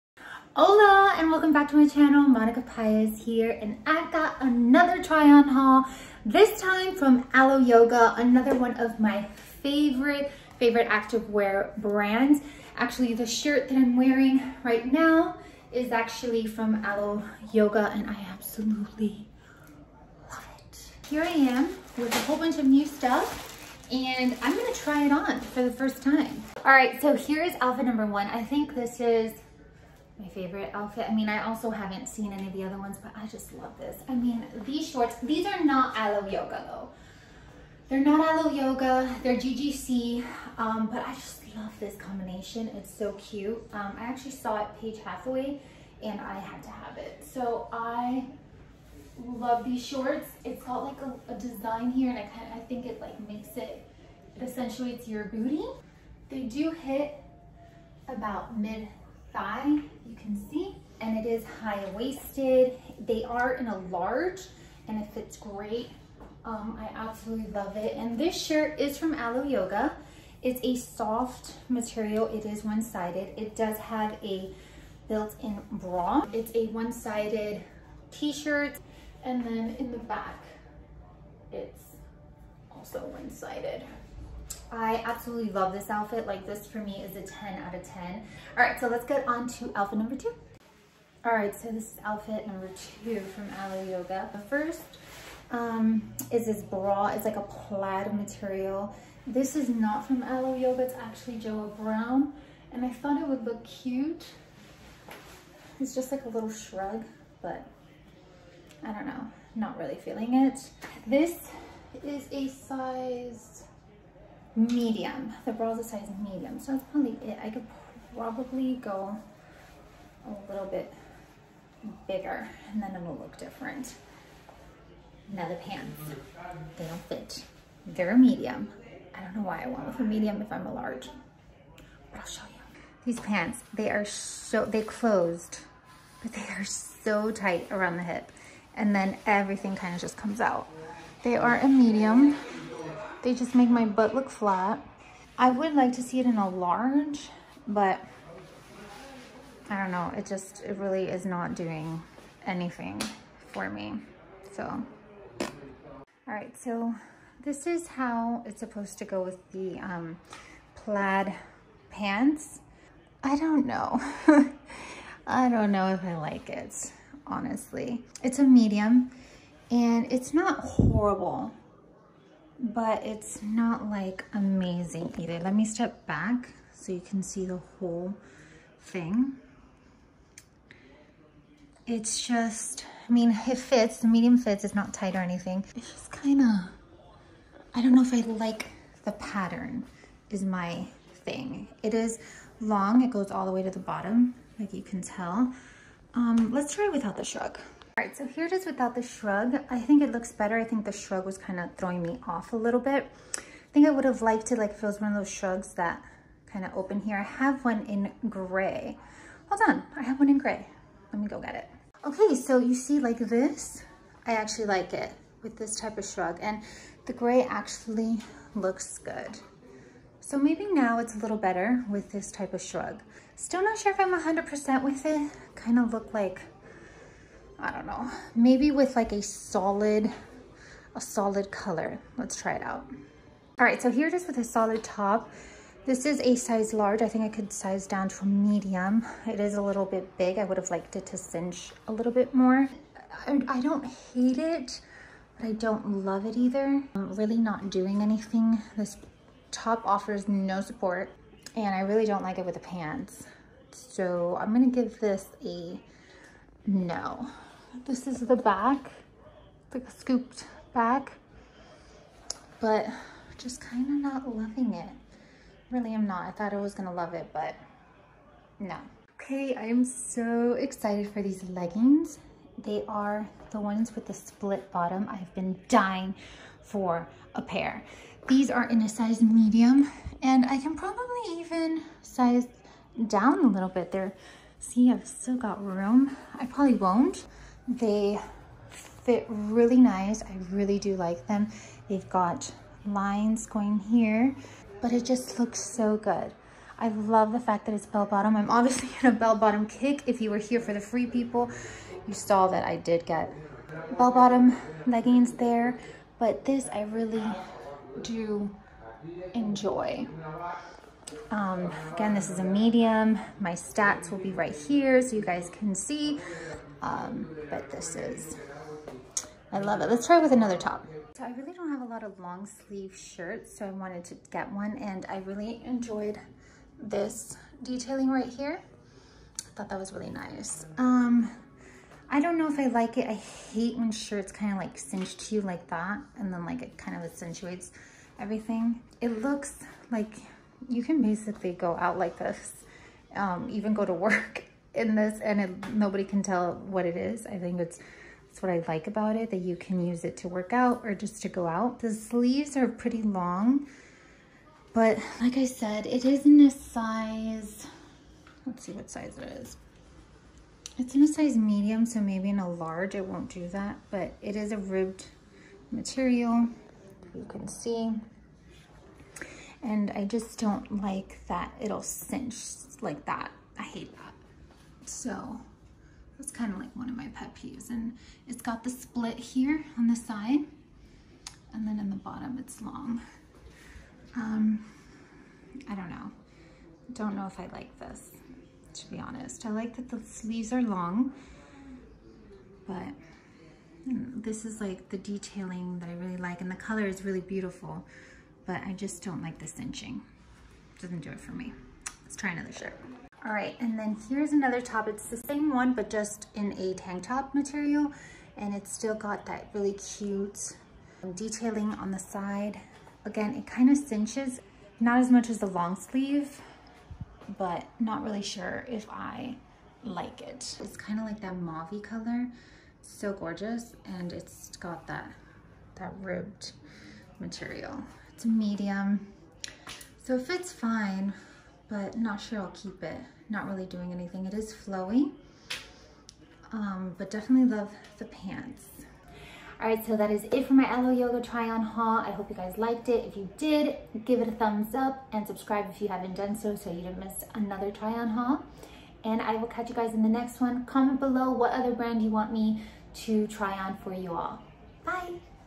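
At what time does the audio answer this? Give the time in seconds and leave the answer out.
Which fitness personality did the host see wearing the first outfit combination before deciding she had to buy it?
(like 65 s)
44 s.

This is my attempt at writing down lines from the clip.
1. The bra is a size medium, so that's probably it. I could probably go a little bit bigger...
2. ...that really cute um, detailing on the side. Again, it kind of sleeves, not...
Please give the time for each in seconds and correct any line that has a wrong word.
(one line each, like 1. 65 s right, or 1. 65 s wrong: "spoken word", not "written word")
1. 115 s right
2. 409 s wrong: "cinches", not "sleeves".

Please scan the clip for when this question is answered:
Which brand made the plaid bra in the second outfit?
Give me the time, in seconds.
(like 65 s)
101 s.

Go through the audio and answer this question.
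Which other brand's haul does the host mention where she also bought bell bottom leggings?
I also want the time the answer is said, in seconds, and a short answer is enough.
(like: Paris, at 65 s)
Free People, at 300 s.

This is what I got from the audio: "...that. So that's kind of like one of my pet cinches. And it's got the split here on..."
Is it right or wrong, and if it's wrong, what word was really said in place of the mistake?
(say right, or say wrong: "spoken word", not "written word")
wrong: "peeves", not "cinches".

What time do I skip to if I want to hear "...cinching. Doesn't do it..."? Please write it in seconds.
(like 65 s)
399 s.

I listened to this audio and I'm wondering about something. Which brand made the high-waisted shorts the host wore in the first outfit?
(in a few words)
GGC.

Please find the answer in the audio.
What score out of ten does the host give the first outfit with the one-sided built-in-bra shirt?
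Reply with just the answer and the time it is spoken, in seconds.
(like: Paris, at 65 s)
10, at 87 s.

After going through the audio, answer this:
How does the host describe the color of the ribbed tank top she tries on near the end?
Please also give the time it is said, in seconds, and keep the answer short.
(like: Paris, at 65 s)
Mauve, at 421 s.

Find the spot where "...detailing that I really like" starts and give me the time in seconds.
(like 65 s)
394 s.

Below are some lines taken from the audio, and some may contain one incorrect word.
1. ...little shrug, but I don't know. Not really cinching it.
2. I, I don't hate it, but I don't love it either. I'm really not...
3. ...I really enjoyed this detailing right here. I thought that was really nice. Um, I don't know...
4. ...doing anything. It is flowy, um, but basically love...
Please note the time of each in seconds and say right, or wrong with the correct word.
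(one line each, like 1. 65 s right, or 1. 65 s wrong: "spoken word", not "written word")
1. 106 s wrong: "feeling", not "cinching"
2. 243 s right
3. 325 s right
4. 433 s wrong: "definitely", not "basically".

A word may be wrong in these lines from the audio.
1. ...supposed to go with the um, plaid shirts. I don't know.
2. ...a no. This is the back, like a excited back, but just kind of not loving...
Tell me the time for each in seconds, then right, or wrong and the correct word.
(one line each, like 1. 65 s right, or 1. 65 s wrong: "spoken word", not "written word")
1. 158 s wrong: "pants", not "shirts"
2. 255 s wrong: "scooped", not "excited".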